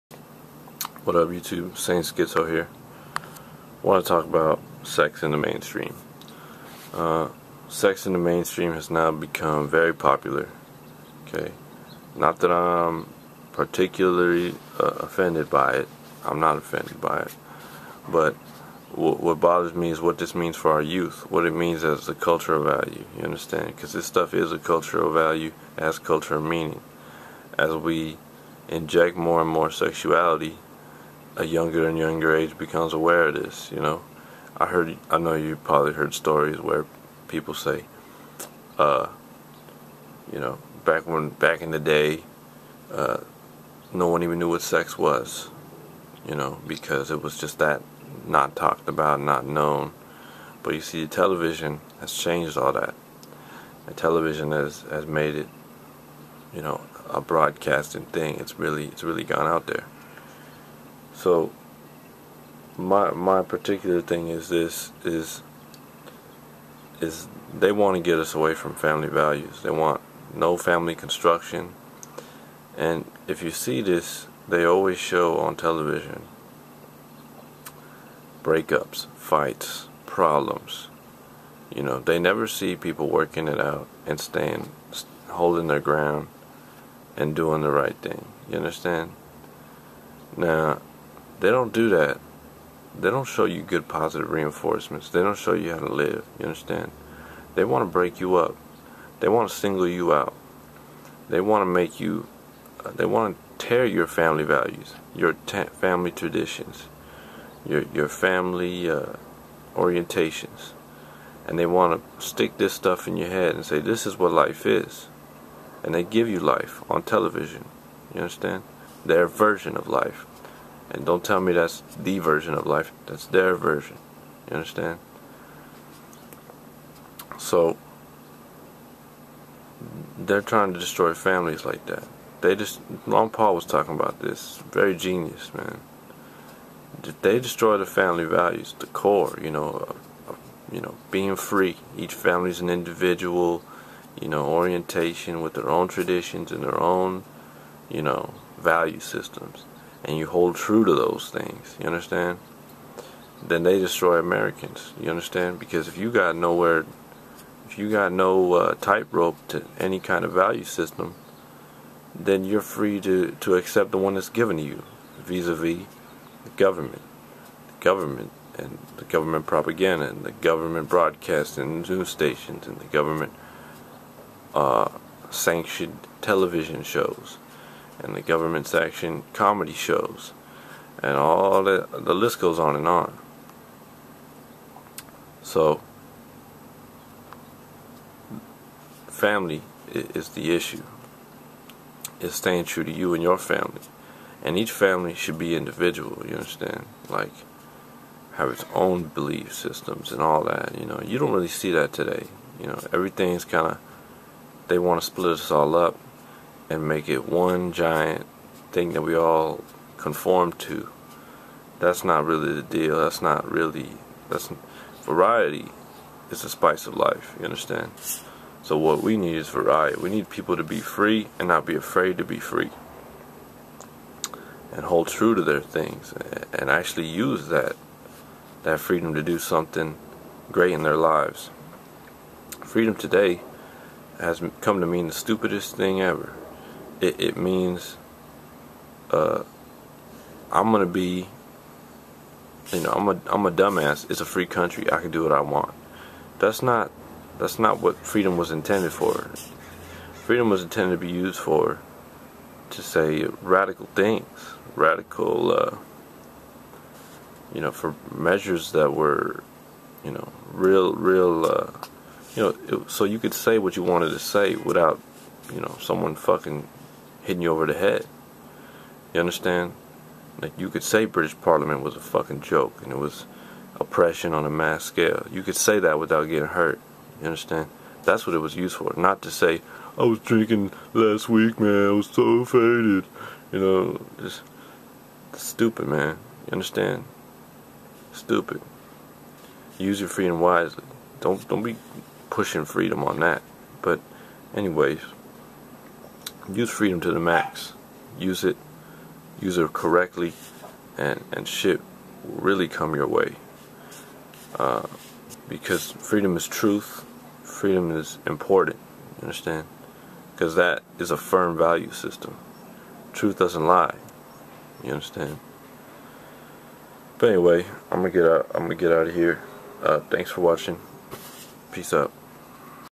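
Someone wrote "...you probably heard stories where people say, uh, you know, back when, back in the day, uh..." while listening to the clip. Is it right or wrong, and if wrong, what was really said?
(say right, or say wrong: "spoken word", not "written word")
right.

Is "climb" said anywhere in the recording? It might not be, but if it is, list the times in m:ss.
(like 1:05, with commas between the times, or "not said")
not said.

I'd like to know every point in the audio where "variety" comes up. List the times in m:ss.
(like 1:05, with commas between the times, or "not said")
3:35, 3:39.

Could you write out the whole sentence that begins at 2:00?
And don't tell me that's the version of life.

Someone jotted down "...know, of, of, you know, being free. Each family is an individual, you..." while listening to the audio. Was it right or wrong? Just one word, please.
right.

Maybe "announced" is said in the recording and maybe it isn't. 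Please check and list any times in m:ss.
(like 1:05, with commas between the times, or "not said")
not said.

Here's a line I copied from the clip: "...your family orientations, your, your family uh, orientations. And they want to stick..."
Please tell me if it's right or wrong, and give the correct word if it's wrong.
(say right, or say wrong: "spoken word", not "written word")
wrong: "traditions", not "orientations".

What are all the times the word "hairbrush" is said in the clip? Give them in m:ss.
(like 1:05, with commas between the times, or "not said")
not said.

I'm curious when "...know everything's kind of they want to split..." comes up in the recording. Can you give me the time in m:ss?
3:22.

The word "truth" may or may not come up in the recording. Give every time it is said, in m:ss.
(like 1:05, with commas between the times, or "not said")
5:06, 5:13.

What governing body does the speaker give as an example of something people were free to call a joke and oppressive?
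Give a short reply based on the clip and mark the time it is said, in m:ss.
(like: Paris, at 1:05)
British Parliament, at 4:31.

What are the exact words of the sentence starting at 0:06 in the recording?
Uh, sex in the mainstream has now become very popular.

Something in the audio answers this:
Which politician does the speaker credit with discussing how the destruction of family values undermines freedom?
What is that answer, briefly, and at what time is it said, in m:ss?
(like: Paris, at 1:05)
Ron Paul, at 2:13.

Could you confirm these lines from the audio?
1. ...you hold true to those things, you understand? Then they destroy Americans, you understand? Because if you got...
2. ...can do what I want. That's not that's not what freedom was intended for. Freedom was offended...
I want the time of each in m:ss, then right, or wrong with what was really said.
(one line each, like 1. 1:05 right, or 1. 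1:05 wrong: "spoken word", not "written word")
1. 2:30 right
2. 4:05 wrong: "intended", not "offended".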